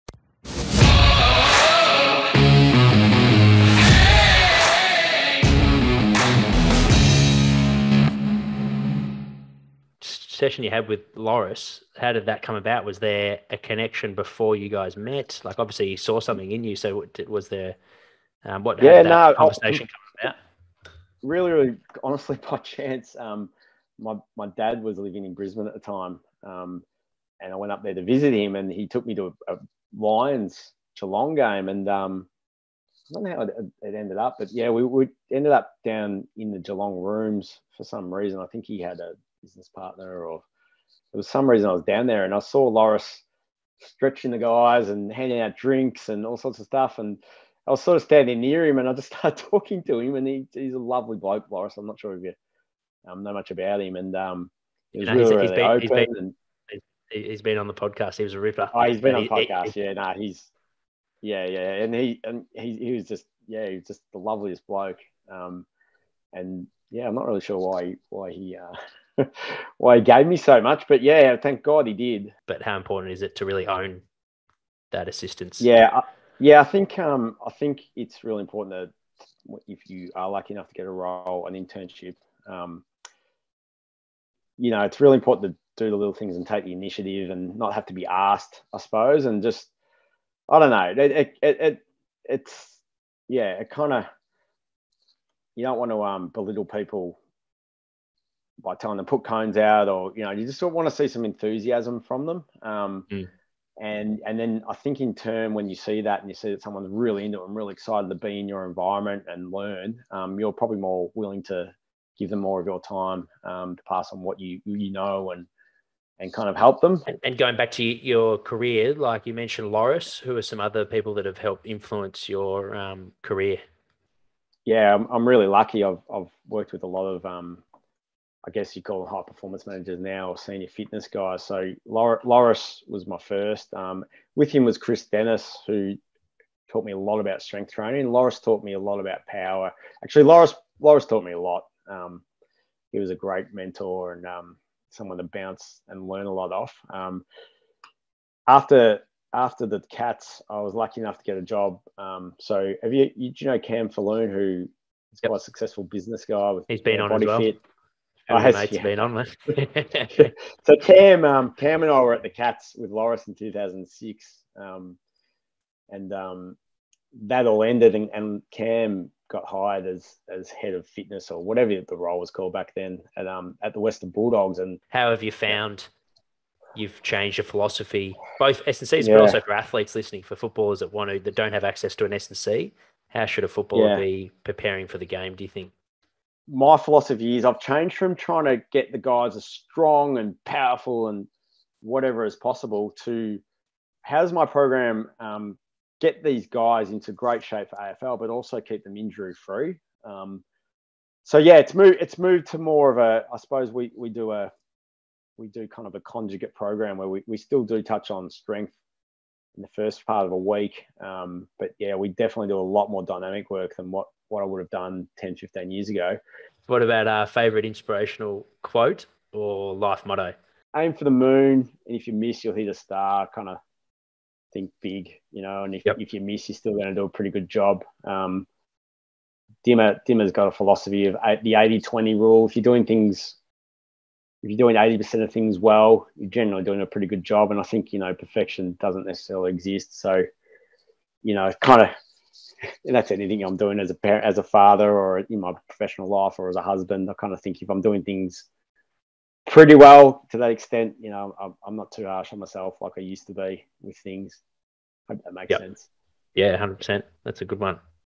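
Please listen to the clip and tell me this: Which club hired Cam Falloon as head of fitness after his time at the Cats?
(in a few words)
Western Bulldogs.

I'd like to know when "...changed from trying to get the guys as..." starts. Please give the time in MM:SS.
03:07.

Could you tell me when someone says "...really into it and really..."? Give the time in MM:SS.
01:46.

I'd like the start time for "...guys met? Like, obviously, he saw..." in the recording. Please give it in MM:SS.
00:14.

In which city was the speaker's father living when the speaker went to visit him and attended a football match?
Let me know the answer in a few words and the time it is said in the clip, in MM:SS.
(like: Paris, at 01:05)
Brisbane, at 00:25.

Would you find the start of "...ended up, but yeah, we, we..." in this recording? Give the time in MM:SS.
00:33.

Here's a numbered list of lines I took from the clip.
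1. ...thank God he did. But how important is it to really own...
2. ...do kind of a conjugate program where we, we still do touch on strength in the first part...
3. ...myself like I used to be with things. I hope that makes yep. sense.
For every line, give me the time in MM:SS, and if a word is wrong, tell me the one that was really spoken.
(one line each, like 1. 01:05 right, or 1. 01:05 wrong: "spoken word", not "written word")
1. 01:11 right
2. 03:25 right
3. 04:12 right.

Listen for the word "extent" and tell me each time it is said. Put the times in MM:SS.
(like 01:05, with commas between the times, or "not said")
04:10.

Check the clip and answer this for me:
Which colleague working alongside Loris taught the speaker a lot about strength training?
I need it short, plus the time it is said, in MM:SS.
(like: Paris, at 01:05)
Chris Dennis, at 02:14.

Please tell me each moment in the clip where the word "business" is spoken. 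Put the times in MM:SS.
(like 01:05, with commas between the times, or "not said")
00:39, 02:35.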